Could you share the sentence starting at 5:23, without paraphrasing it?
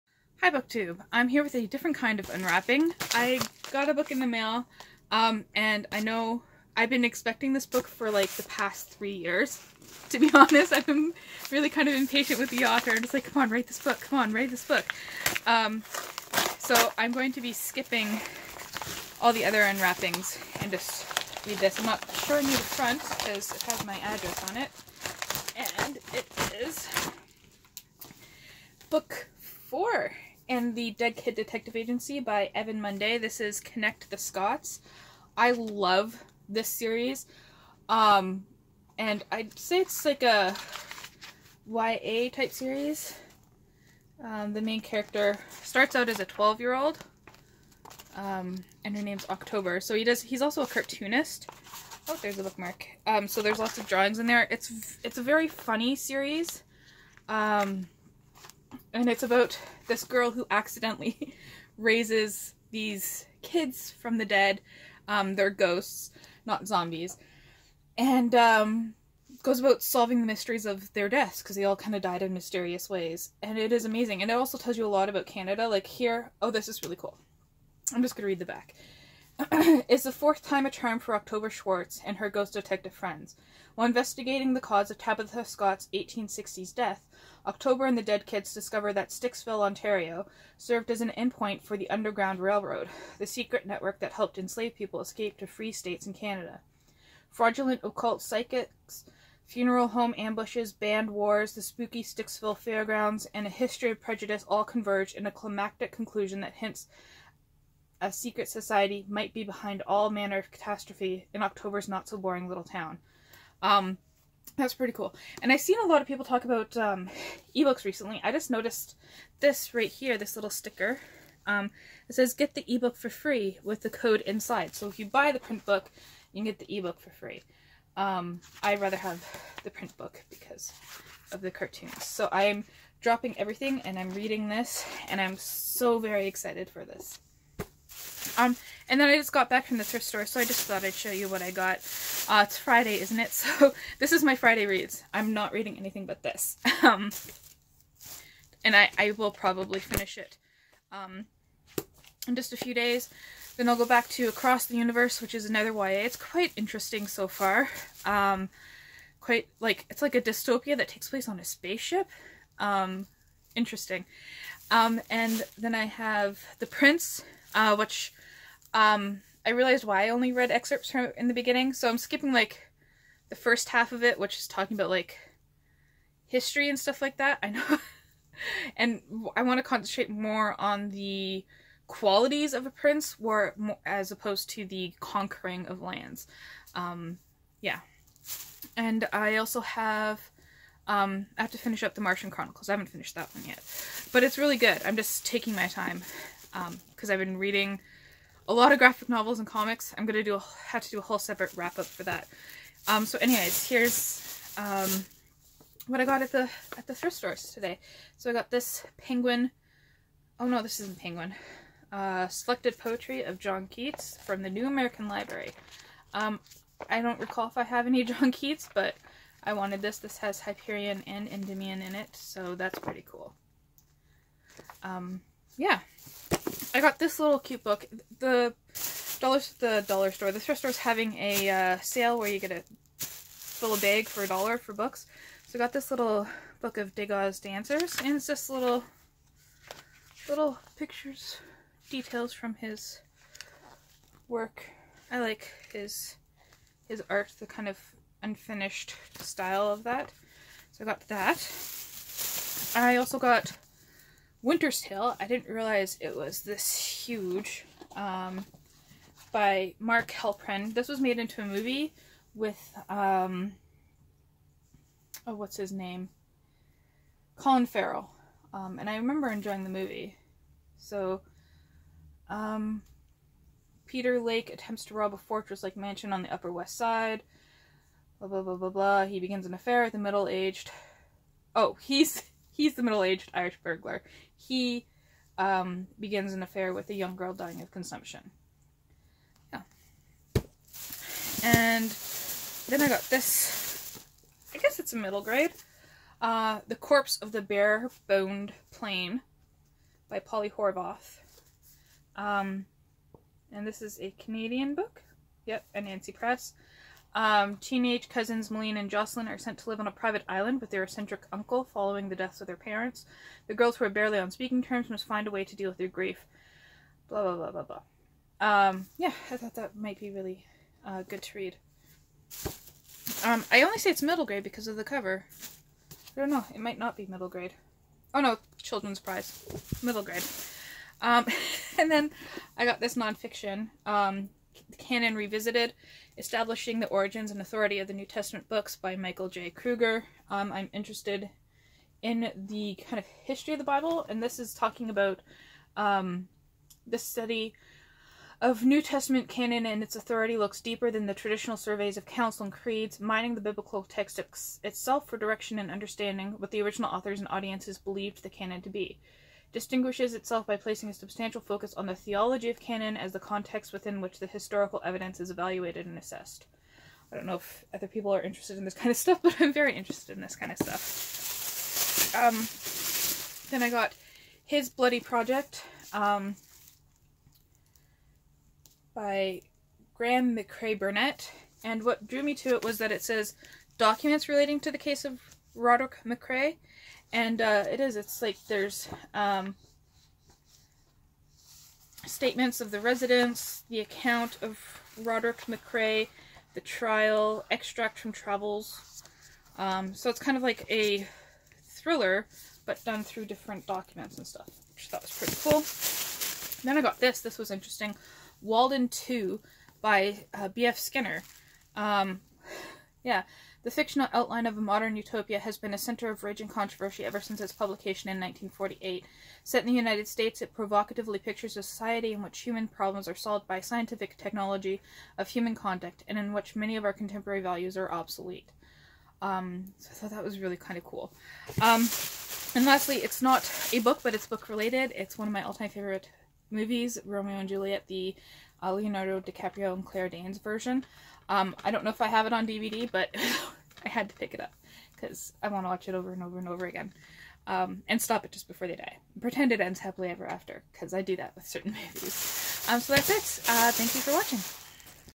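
Um, I only say it's middle grade because of the cover.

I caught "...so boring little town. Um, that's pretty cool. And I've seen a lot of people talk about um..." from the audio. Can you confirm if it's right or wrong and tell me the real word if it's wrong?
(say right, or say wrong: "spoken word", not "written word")
right.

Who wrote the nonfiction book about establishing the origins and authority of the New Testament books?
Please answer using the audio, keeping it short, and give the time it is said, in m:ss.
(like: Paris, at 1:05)
Michael J. Kruger, at 5:38.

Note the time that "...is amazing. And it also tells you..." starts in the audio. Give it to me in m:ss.
1:13.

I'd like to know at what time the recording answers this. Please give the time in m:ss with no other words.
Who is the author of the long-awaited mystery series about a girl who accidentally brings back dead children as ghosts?
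0:32.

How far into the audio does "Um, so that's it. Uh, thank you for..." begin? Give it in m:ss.
7:32.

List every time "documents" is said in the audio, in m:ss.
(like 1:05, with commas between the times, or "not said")
6:23, 6:43.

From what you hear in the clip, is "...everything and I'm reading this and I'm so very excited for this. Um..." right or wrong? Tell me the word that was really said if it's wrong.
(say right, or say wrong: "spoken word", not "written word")
right.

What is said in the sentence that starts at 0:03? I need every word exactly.
I got a book in the mail um, and I know I've been expecting this book for like the past three years.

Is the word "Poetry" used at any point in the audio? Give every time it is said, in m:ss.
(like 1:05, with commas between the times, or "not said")
3:32.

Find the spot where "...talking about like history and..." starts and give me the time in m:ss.
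2:54.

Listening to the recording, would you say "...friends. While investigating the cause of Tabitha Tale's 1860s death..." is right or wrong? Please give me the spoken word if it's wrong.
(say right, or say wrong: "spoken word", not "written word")
wrong: "Scott", not "Tale".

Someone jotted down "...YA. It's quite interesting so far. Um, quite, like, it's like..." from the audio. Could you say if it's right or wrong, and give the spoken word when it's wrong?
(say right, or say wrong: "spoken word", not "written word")
right.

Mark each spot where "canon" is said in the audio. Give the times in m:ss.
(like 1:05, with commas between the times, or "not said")
5:34, 5:49, 5:58, 6:02.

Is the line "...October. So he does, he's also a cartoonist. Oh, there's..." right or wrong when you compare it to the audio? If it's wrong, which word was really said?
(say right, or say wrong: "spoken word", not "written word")
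right.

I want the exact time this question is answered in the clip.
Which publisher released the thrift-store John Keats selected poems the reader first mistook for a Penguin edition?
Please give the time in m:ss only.
3:34.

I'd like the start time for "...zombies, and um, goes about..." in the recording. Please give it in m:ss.
1:06.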